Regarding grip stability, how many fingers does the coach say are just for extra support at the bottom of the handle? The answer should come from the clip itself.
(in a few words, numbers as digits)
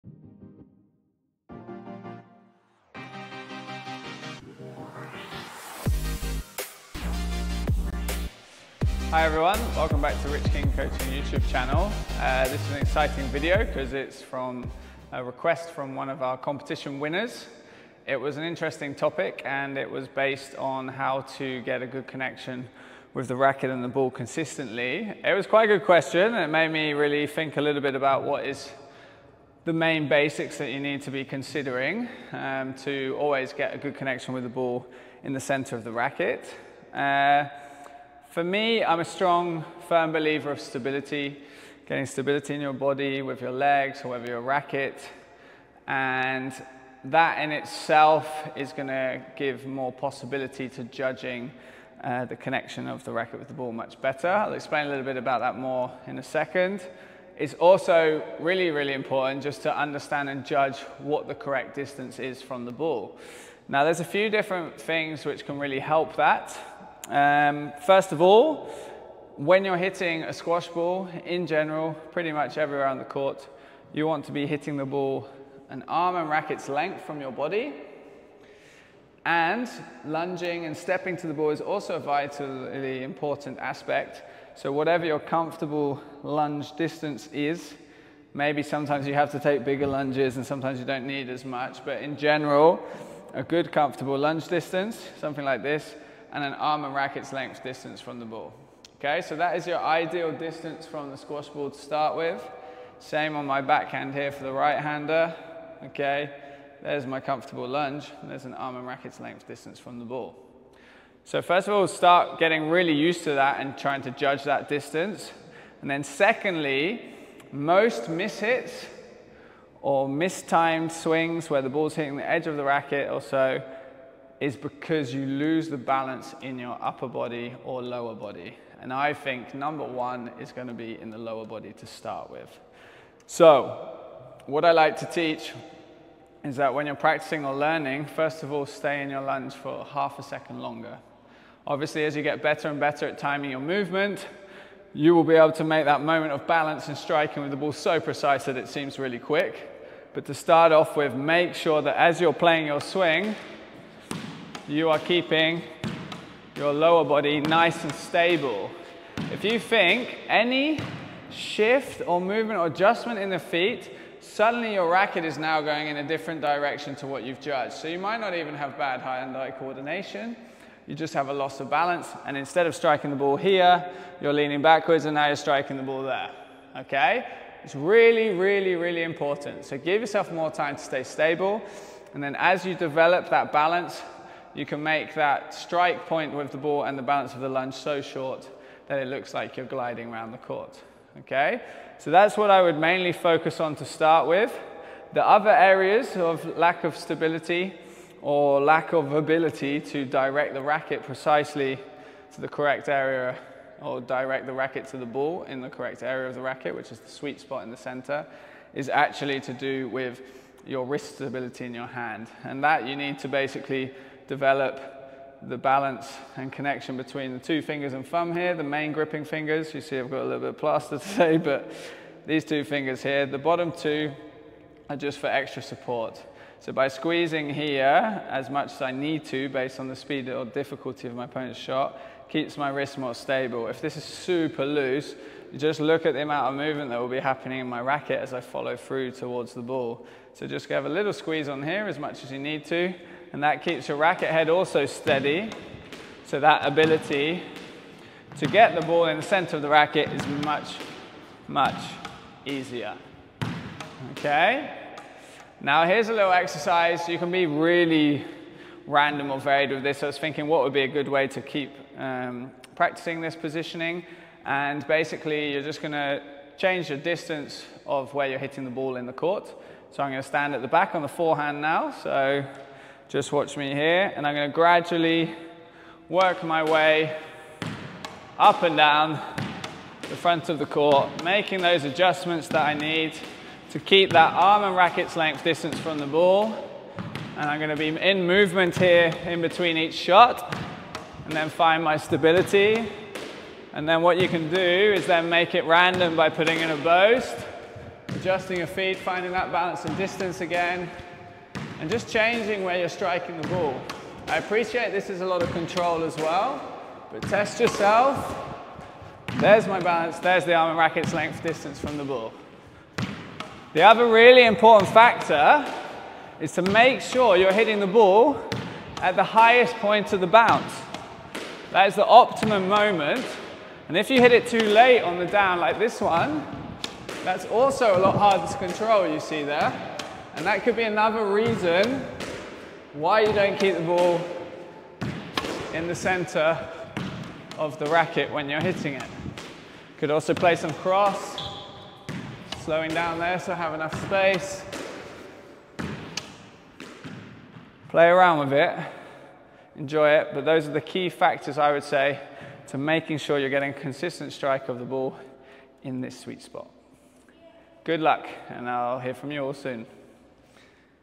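2.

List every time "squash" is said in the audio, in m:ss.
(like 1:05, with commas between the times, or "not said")
1:10, 1:41.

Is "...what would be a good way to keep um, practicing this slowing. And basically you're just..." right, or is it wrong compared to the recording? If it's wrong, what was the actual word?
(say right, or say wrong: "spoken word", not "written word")
wrong: "positioning", not "slowing".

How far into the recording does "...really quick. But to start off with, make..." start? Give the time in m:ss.
2:28.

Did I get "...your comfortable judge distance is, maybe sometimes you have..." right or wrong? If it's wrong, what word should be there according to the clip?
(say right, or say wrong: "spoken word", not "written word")
wrong: "lunge", not "judge".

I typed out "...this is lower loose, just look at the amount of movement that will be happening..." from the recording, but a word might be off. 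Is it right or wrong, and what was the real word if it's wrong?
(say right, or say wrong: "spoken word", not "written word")
wrong: "super", not "lower".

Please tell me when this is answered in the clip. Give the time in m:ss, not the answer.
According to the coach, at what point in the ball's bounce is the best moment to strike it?
5:19.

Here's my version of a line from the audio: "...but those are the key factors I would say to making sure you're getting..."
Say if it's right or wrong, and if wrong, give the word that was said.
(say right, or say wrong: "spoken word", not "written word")
right.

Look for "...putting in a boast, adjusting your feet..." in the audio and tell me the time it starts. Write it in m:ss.
4:56.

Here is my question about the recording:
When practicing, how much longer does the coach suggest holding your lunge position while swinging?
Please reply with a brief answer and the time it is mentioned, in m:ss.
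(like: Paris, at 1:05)
Half a second, at 2:19.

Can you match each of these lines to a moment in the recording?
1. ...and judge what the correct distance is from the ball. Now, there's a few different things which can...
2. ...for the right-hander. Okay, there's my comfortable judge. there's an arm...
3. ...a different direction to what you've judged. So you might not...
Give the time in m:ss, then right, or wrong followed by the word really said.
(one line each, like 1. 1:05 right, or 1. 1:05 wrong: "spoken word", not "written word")
1. 1:00 right
2. 1:44 wrong: "lunge", not "judge"
3. 2:45 right.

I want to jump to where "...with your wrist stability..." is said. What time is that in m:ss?
3:29.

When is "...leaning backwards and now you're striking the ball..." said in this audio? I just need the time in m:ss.
2:54.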